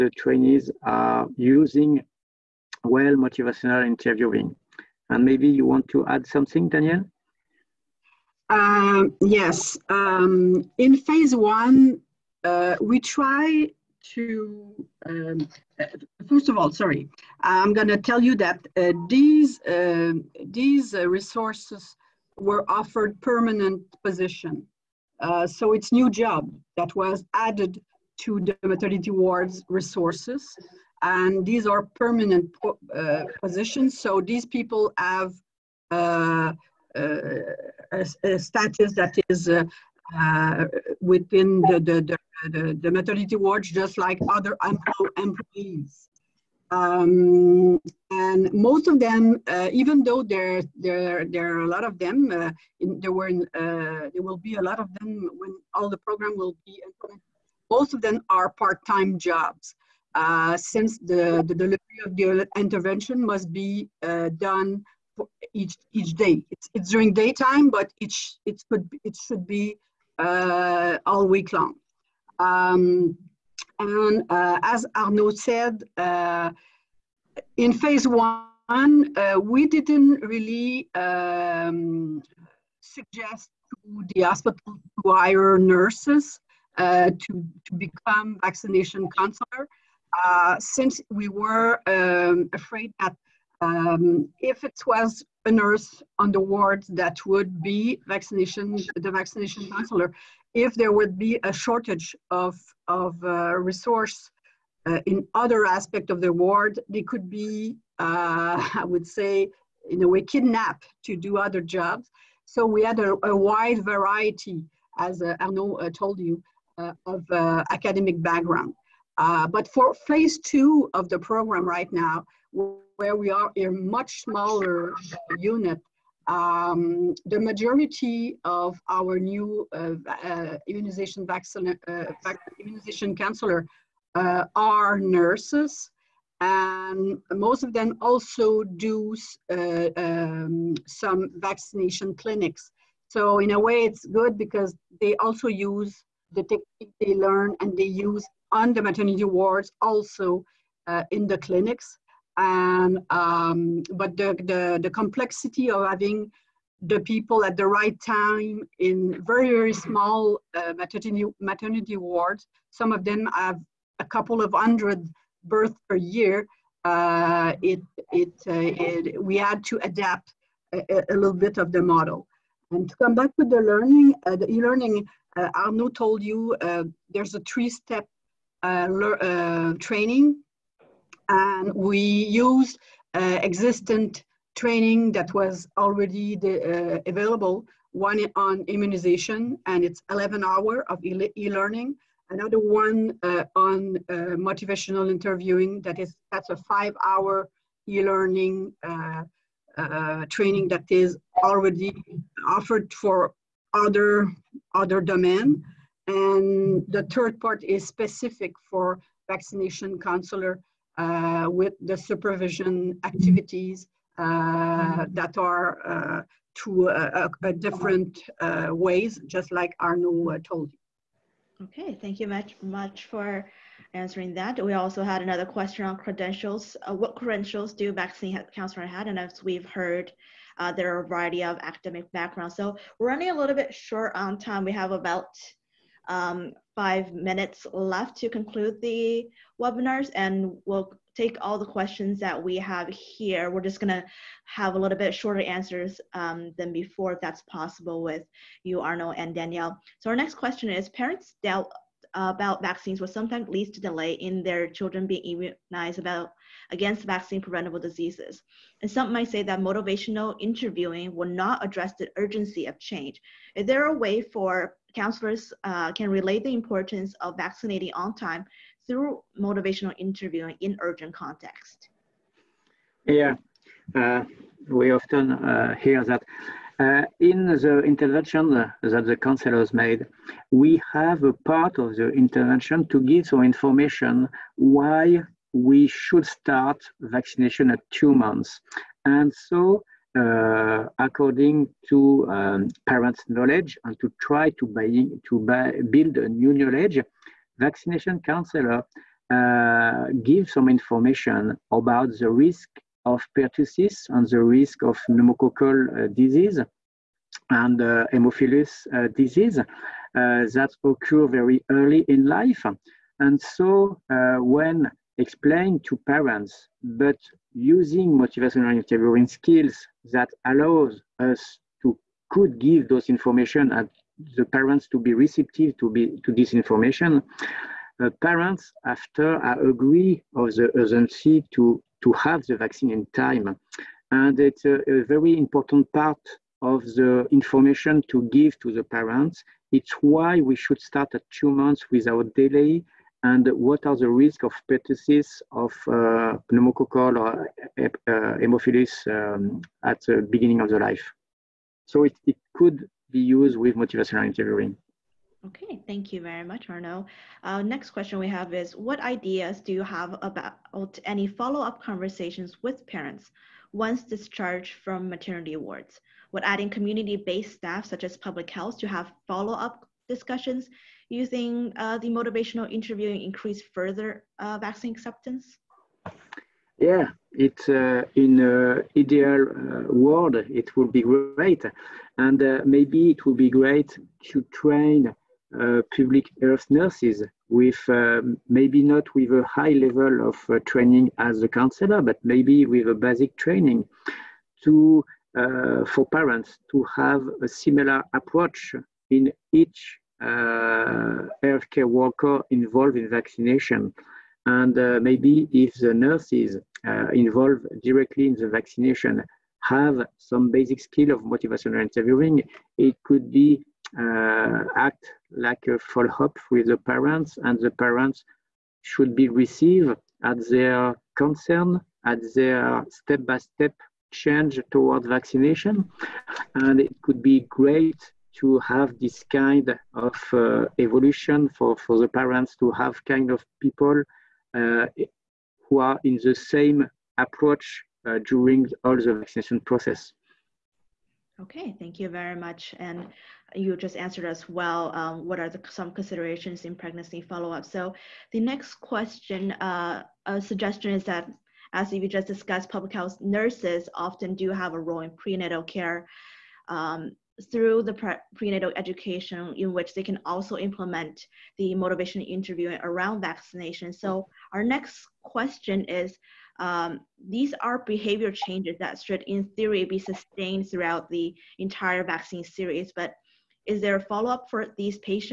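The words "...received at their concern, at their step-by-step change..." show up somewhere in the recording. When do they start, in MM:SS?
06:59.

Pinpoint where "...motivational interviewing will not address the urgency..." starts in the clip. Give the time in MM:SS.
04:19.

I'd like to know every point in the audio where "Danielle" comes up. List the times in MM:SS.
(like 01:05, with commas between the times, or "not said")
00:06, 04:09.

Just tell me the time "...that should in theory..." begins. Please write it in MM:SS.
07:48.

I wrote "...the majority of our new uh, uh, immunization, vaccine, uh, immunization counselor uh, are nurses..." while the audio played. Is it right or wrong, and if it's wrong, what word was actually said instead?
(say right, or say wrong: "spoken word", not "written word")
right.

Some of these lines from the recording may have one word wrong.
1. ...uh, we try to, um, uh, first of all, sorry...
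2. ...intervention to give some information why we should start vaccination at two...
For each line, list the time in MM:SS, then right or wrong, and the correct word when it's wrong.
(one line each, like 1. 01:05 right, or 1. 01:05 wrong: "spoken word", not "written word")
1. 00:12 right
2. 04:42 right.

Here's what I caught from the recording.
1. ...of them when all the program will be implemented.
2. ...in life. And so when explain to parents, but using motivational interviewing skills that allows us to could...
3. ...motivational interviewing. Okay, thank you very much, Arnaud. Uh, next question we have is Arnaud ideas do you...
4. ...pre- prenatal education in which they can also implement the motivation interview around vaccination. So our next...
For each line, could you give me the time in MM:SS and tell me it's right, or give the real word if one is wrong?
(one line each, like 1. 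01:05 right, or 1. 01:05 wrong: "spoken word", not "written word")
1. 00:54 right
2. 05:12 right
3. 05:53 wrong: "What", not "Arnaud"
4. 07:37 right.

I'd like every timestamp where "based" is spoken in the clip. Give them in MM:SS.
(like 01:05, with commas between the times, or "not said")
06:07.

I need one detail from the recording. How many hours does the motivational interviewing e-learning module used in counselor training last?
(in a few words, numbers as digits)
5.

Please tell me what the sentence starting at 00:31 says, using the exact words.
And these are permanent po uh, positions.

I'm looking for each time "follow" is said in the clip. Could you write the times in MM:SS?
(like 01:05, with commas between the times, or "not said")
06:01, 06:09, 06:55, 07:27, 07:53.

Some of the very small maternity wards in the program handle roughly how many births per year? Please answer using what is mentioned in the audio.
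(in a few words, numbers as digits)
A couple of hundred.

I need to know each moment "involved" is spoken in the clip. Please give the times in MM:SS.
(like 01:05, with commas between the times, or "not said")
06:42, 06:47.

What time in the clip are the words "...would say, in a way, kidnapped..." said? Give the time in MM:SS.
01:48.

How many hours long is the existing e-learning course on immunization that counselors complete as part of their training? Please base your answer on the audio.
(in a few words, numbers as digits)
11.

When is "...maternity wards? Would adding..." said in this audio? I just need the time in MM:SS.
06:05.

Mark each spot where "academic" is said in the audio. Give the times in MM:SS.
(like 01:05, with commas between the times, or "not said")
01:57, 03:51.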